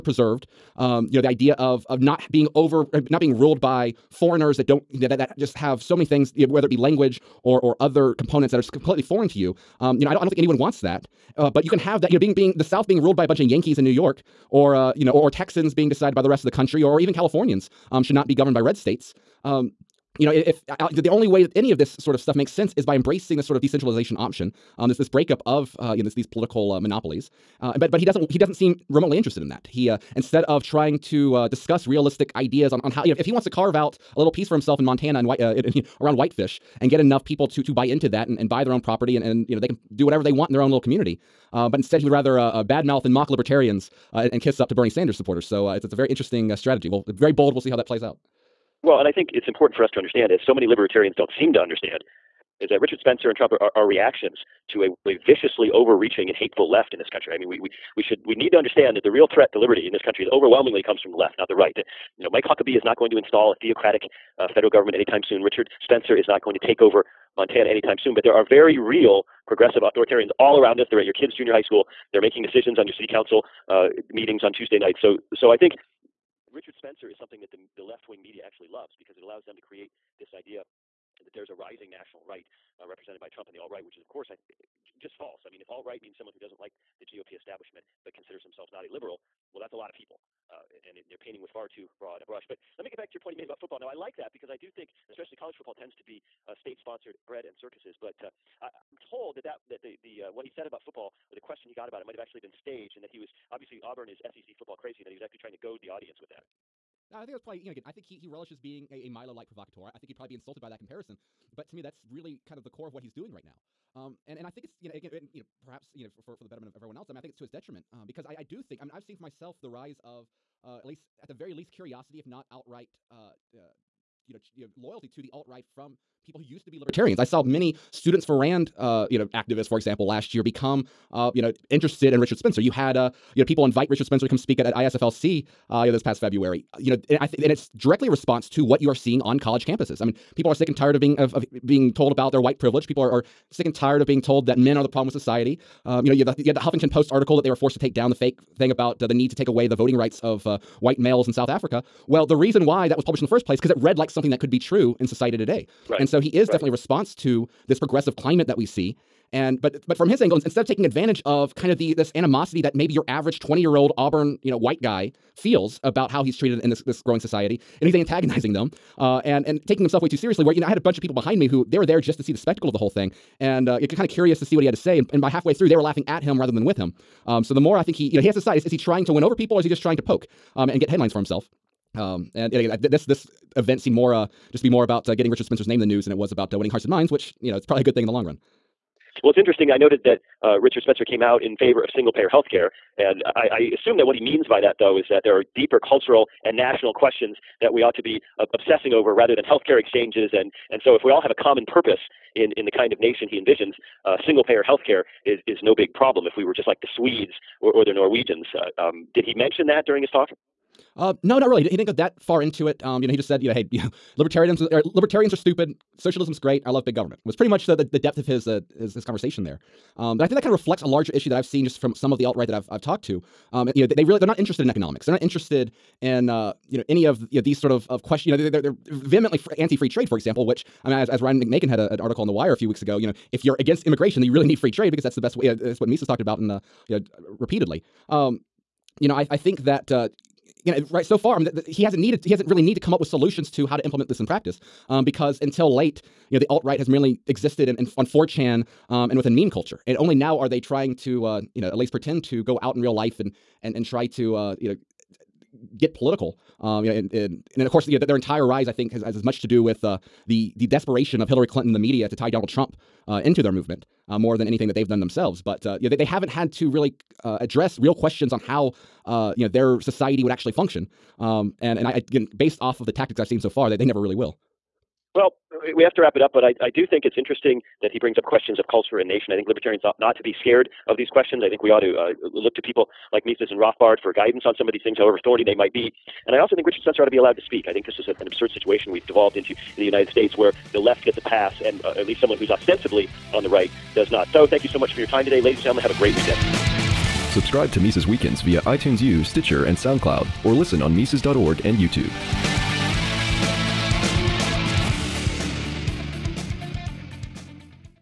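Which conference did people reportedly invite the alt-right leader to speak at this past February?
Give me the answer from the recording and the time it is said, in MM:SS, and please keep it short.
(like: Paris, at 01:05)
ISFLC, at 02:14.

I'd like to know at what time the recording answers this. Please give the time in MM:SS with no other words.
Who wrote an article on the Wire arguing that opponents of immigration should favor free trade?
03:51.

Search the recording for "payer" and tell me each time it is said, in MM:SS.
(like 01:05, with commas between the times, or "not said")
03:12, 03:24.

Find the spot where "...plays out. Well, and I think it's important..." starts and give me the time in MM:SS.
00:47.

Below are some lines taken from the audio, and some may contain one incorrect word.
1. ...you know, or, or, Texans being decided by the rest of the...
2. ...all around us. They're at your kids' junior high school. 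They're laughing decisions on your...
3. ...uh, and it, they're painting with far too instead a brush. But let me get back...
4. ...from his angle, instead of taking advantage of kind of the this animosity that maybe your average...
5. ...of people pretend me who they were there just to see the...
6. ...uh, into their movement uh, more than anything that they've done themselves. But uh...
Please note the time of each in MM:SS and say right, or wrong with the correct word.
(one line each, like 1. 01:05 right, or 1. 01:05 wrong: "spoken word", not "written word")
1. 00:14 right
2. 01:10 wrong: "making", not "laughing"
3. 01:30 wrong: "broad", not "instead"
4. 02:39 right
5. 02:50 wrong: "behind", not "pretend"
6. 04:23 right.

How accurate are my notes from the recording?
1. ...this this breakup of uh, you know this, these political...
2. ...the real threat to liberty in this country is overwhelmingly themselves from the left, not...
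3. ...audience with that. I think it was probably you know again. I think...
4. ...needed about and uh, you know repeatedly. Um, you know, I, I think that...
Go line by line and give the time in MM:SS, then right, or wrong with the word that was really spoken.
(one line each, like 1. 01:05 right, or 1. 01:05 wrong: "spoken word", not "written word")
1. 00:24 right
2. 00:59 wrong: "comes", not "themselves"
3. 01:45 right
4. 03:56 wrong: "talked", not "needed".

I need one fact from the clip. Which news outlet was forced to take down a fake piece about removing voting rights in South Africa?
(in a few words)
Huffington Post.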